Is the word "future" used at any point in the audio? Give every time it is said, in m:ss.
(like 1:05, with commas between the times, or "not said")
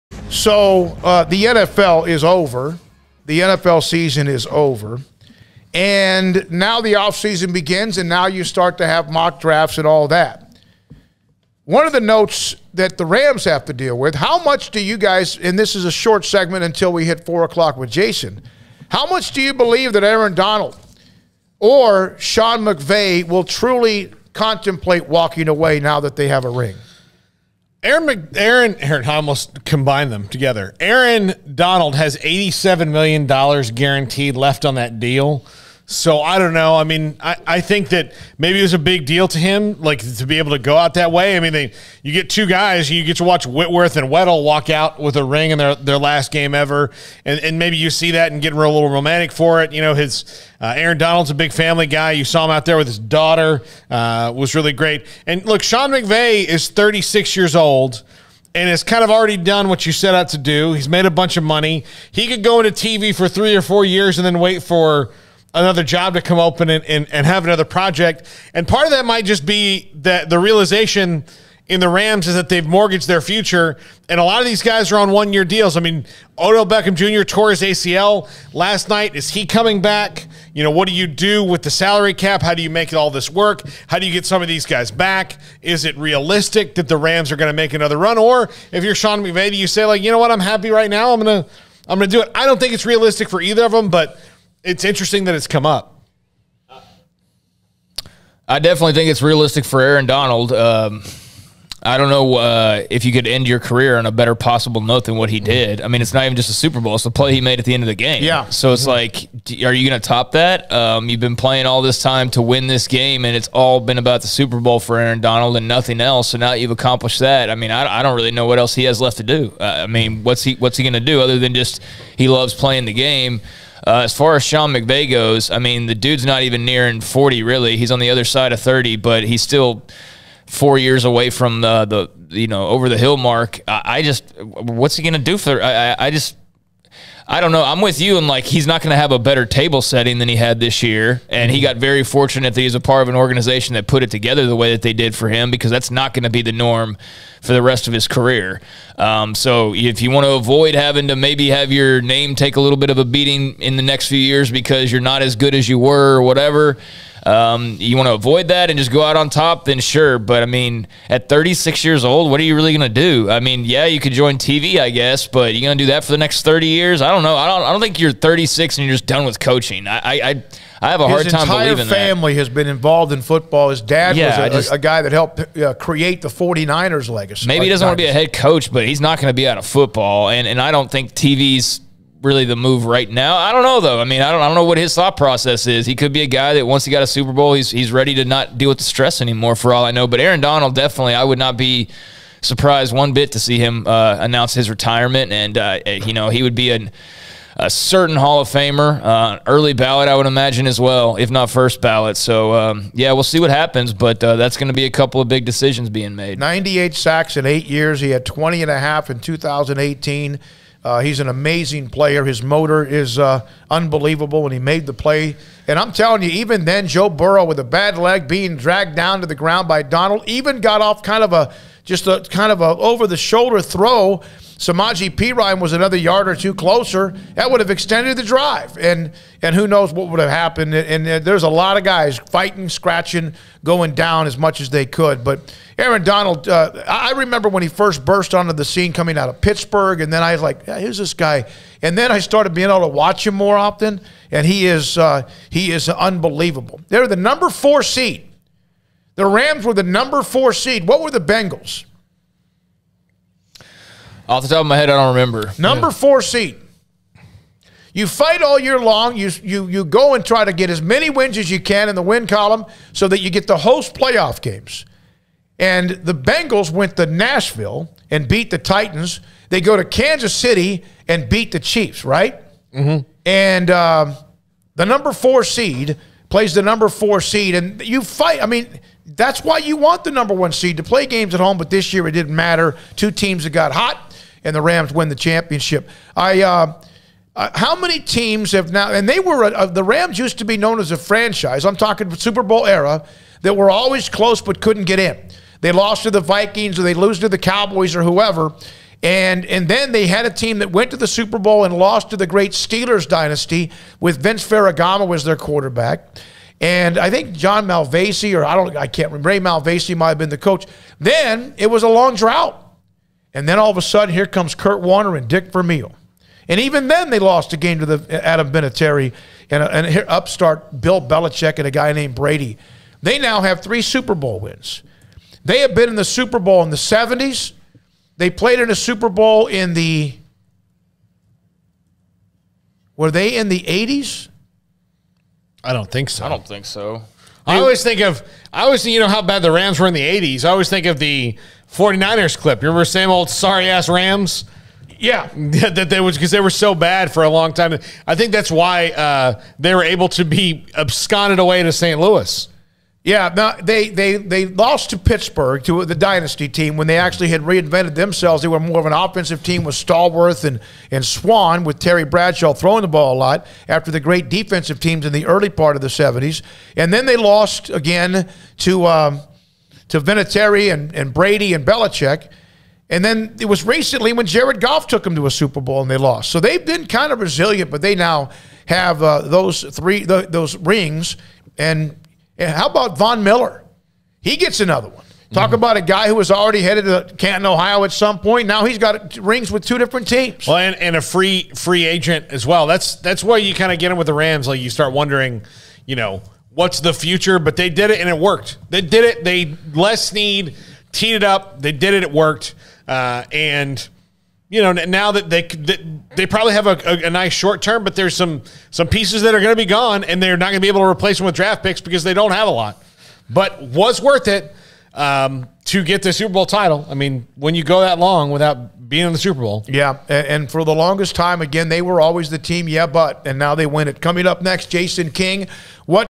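1:13, 6:36.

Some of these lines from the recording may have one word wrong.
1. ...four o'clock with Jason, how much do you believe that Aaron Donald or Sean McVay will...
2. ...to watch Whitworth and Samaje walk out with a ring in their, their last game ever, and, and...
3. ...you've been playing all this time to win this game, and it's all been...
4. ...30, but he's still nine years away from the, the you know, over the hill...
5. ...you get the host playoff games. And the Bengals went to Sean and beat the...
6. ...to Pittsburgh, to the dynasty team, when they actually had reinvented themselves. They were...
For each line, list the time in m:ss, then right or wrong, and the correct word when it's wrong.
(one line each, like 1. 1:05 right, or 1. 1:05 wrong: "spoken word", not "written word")
1. 0:17 right
2. 0:43 wrong: "Weddle", not "Samaje"
3. 1:51 right
4. 2:08 wrong: "four", not "nine"
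5. 4:23 wrong: "Nashville", not "Sean"
6. 5:54 right.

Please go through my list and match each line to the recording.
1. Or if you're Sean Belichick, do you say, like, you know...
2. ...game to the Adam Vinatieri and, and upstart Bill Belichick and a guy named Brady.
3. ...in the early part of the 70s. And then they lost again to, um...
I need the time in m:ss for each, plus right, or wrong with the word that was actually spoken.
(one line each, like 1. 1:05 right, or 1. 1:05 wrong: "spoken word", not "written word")
1. 1:28 wrong: "McVay", not "Belichick"
2. 5:17 right
3. 6:05 right.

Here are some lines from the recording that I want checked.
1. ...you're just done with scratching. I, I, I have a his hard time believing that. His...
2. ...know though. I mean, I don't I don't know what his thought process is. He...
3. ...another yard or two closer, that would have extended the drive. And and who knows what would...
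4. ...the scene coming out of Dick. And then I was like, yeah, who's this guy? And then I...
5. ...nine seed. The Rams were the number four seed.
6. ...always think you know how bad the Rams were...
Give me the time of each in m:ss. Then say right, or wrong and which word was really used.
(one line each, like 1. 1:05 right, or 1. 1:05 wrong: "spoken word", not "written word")
1. 2:48 wrong: "coaching", not "scratching"
2. 3:03 right
3. 3:45 right
4. 3:58 wrong: "Pittsburgh", not "Dick"
5. 4:07 wrong: "four", not "nine"
6. 5:38 right.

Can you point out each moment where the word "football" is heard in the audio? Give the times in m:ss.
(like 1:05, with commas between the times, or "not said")
2:53, 2:59.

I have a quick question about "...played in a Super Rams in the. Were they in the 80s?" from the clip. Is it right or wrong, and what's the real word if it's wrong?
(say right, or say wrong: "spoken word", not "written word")
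wrong: "Bowl", not "Rams".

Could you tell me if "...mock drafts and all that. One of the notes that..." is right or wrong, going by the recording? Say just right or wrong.
right.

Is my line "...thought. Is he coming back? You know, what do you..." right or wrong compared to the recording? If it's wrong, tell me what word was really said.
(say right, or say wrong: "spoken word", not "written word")
wrong: "night", not "thought".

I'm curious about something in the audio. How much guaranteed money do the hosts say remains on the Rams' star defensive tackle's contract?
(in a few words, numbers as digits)
$87 million.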